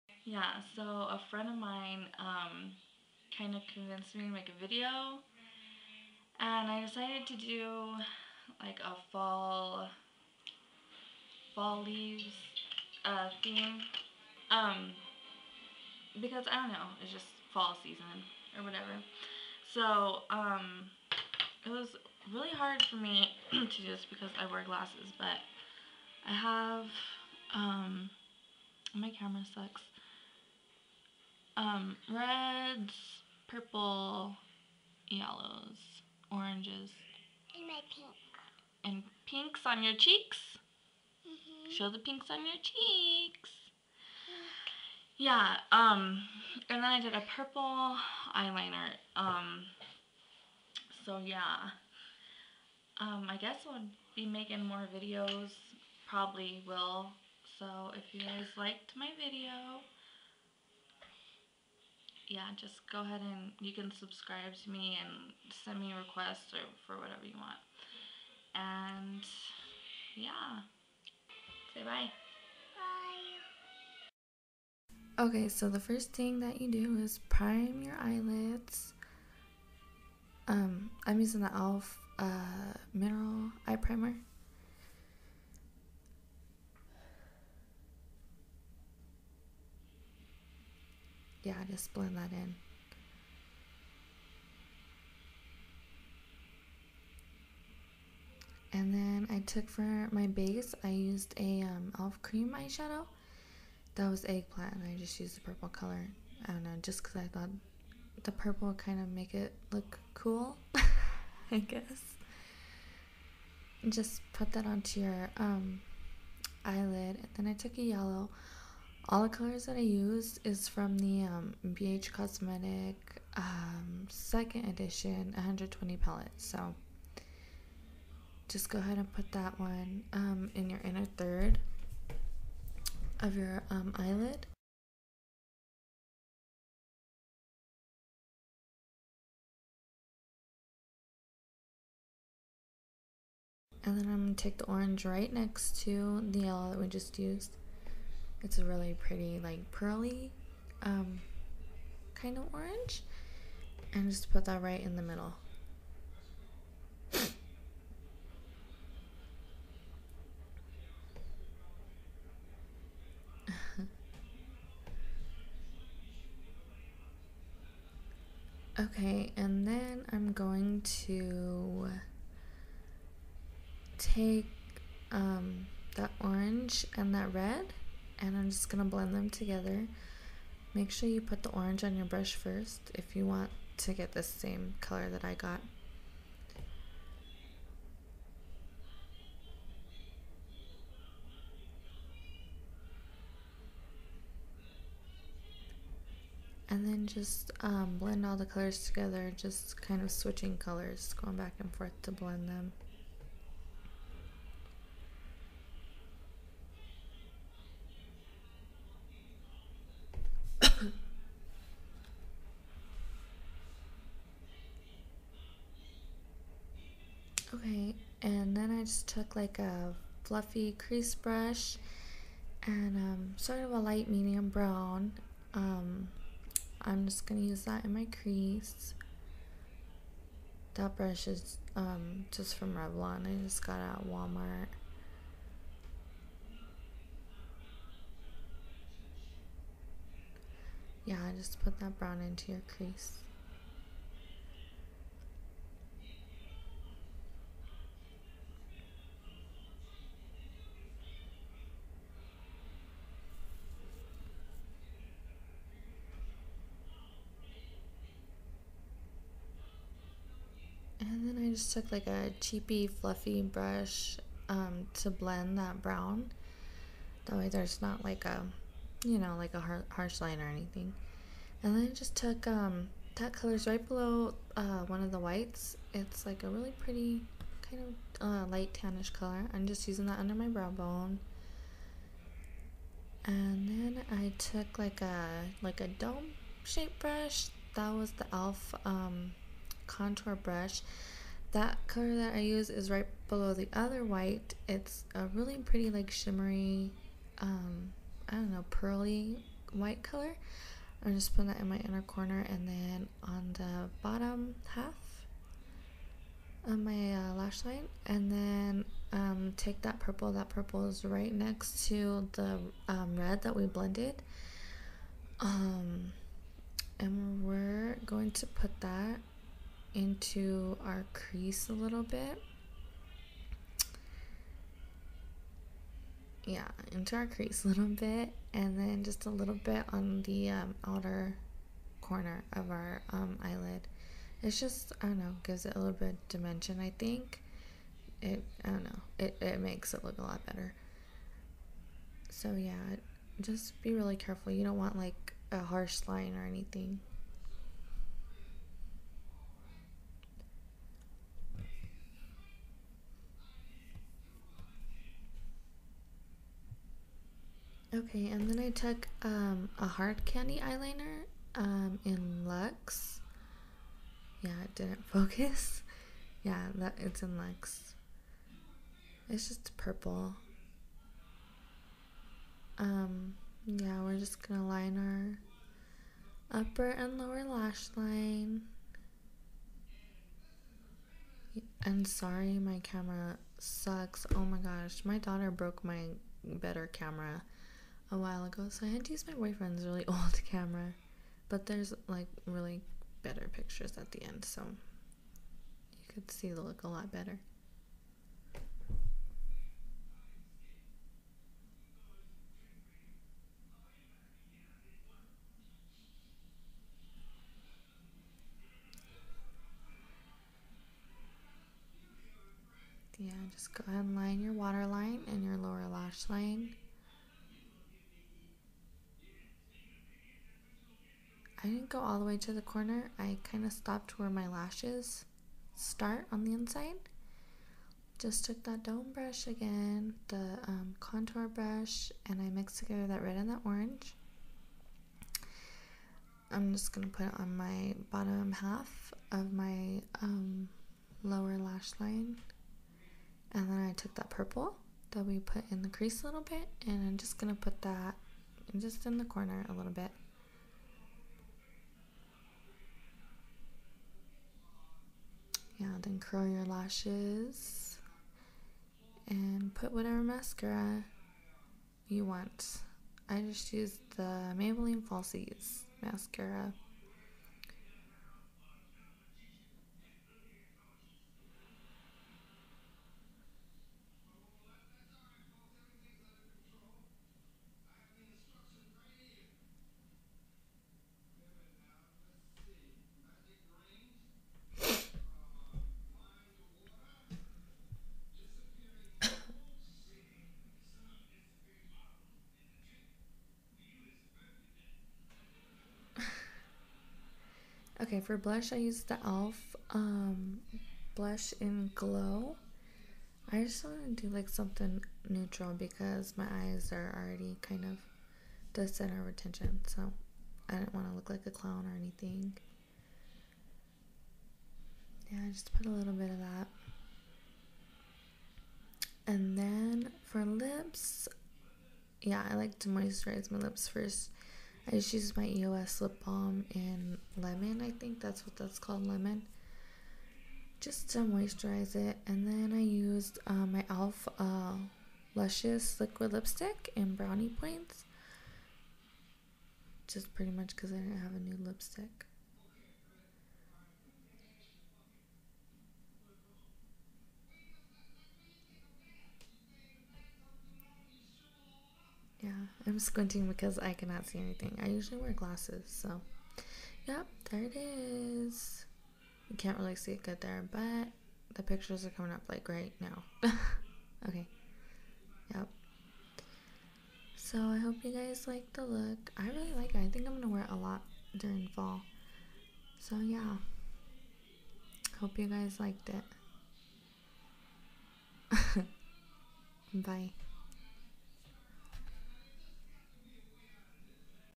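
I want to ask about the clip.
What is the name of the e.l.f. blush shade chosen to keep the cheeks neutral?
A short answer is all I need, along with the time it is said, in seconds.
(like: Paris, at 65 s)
Glow, at 501 s.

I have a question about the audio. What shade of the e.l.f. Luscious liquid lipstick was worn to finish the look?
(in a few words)
Brownie Points.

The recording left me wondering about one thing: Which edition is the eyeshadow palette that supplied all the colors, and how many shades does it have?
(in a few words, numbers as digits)
Second edition 120.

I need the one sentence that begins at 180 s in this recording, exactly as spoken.
Make sure you put the orange on your brush first if you want to get the same color that I got.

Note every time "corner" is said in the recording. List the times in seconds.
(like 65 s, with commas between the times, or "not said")
302 s, 332 s, 422 s, 449 s.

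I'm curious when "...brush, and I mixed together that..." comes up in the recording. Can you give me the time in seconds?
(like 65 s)
431 s.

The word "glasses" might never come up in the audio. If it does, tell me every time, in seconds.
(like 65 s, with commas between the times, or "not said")
24 s, 555 s.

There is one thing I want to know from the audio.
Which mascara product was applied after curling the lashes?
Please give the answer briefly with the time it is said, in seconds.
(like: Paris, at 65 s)
Maybelline Falsies, at 464 s.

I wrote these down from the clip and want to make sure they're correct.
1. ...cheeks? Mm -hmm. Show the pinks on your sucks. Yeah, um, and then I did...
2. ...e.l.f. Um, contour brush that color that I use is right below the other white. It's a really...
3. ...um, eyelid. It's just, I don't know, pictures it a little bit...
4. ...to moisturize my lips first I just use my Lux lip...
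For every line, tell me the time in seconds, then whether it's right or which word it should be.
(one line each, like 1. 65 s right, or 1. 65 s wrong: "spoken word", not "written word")
1. 39 s wrong: "cheeks", not "sucks"
2. 288 s right
3. 333 s wrong: "gives", not "pictures"
4. 522 s wrong: "EOS", not "Lux".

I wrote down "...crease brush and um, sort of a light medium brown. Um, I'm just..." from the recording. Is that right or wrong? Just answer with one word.
right.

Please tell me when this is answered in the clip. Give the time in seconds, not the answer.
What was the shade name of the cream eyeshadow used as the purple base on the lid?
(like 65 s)
104 s.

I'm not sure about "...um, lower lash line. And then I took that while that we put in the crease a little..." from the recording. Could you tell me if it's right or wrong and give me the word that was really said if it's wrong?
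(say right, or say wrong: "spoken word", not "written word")
wrong: "purple", not "while".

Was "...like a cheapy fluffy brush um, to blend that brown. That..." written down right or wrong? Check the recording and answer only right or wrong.
right.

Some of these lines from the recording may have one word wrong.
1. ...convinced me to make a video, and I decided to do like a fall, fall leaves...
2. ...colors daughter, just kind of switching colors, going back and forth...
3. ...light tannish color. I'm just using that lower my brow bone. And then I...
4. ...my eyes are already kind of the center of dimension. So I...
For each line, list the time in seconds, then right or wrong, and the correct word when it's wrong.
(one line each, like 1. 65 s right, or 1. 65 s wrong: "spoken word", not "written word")
1. 3 s right
2. 198 s wrong: "together", not "daughter"
3. 278 s wrong: "under", not "lower"
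4. 506 s wrong: "attention", not "dimension".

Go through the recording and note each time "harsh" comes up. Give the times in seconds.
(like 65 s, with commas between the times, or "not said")
269 s, 345 s.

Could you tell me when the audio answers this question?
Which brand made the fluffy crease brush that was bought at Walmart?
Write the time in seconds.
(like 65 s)
232 s.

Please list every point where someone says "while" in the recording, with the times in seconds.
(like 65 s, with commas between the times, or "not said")
388 s.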